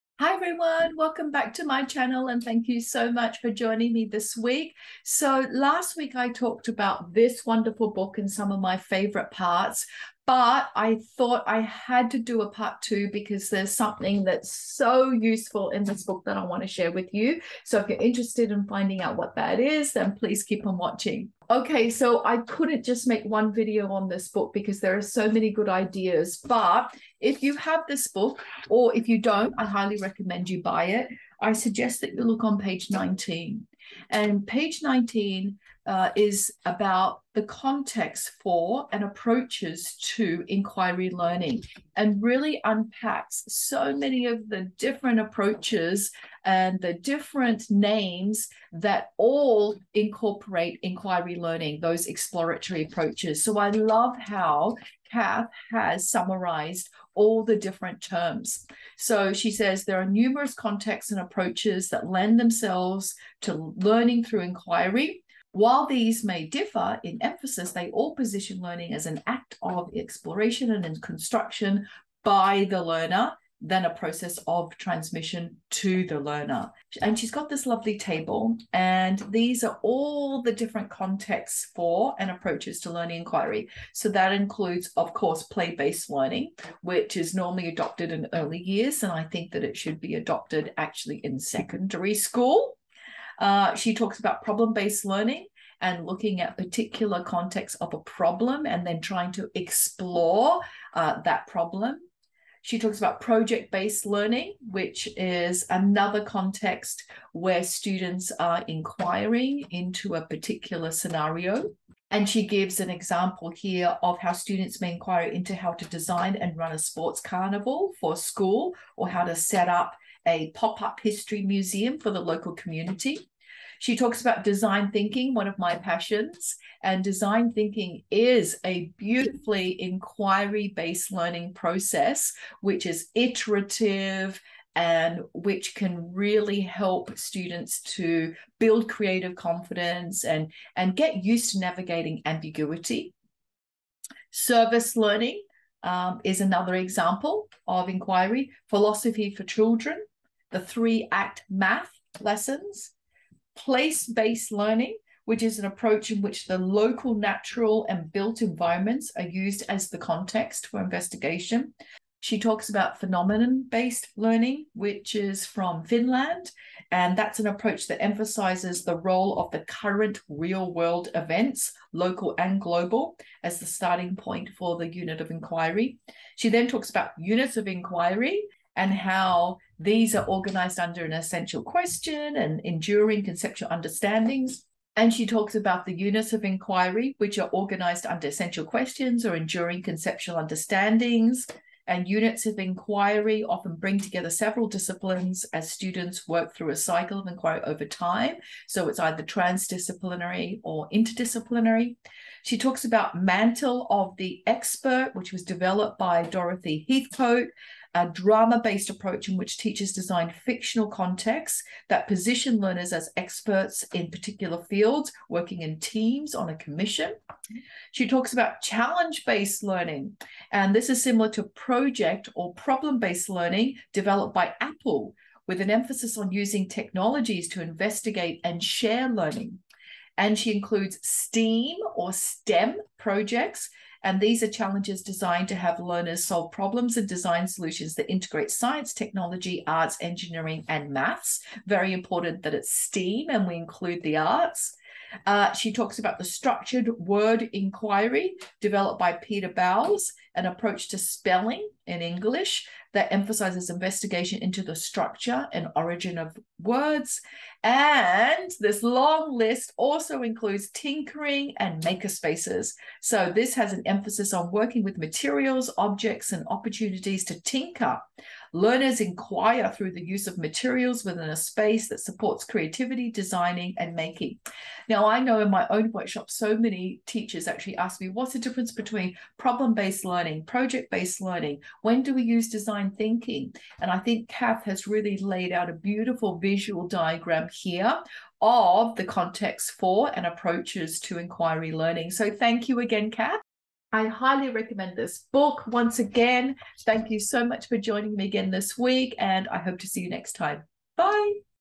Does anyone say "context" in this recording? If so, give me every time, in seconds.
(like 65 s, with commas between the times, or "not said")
37 s, 60 s, 80 s, 97 s, 106 s, 159 s, 210 s, 289 s.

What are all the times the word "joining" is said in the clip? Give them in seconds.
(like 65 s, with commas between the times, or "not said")
3 s, 297 s.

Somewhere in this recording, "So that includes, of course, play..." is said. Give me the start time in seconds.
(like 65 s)
83 s.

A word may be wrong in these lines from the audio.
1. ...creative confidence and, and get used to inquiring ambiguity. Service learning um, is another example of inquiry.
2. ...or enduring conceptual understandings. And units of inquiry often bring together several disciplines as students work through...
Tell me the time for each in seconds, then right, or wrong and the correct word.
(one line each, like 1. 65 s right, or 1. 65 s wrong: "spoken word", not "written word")
1. 138 s wrong: "navigating", not "inquiring"
2. 189 s right.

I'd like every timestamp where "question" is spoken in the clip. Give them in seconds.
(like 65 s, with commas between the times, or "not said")
181 s, 188 s.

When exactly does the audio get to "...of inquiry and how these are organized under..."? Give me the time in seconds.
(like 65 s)
177 s.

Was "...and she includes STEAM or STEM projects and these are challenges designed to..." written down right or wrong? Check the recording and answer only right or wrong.
right.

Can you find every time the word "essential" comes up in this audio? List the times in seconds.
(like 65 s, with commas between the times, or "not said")
181 s, 188 s.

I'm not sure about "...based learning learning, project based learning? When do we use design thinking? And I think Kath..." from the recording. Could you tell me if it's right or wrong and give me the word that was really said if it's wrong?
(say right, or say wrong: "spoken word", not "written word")
right.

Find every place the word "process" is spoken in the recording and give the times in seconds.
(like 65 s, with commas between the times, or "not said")
73 s, 131 s.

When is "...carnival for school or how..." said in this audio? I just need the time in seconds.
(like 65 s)
117 s.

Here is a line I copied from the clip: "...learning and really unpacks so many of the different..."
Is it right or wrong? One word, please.
right.